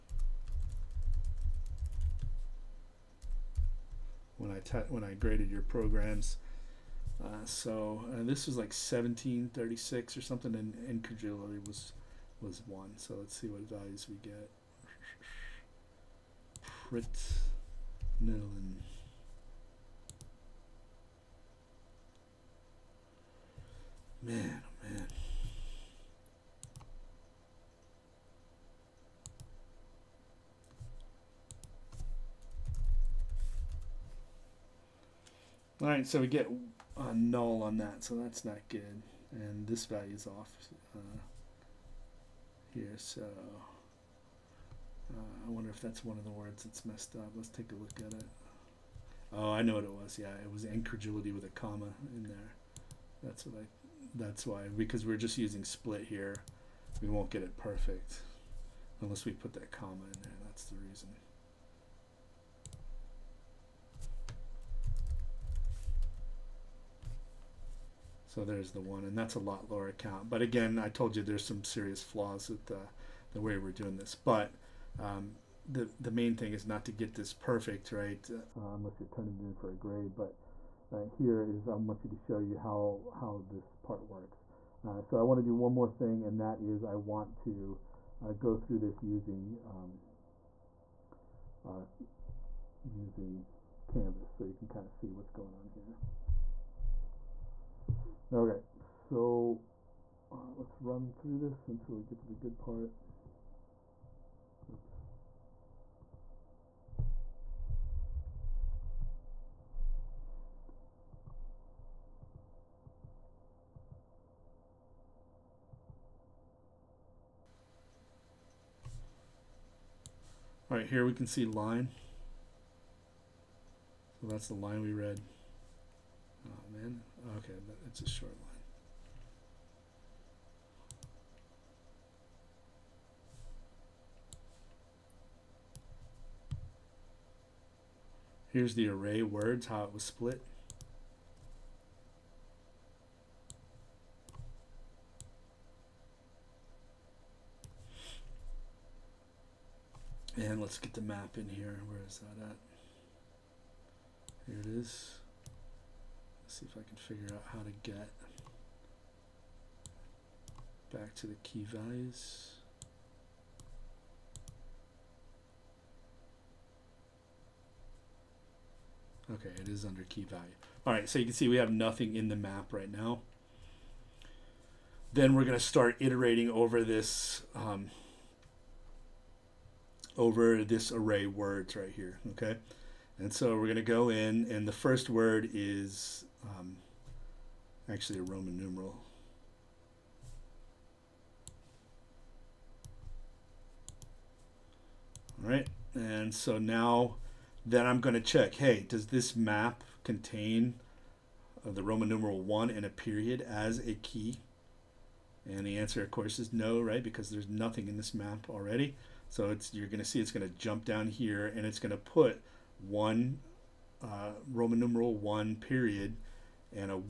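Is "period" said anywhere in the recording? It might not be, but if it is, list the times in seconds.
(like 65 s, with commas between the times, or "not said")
202 s, 215 s.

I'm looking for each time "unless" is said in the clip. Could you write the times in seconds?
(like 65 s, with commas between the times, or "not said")
59 s, 78 s.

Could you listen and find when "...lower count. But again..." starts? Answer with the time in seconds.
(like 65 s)
69 s.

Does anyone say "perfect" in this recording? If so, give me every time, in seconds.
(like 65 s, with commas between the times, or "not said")
57 s, 77 s.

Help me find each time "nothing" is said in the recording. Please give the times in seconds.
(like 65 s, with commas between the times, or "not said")
171 s, 207 s.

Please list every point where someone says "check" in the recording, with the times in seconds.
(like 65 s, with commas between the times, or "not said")
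198 s.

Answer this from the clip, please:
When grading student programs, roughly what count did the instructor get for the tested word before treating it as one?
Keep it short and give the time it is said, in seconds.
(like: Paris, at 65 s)
1736, at 8 s.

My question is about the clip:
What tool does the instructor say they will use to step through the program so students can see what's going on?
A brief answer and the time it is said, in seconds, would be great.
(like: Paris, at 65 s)
Canvas, at 93 s.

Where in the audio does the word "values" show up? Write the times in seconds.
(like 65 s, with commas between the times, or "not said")
13 s, 39 s, 161 s, 170 s.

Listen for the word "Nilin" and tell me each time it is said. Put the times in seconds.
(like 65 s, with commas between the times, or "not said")
18 s.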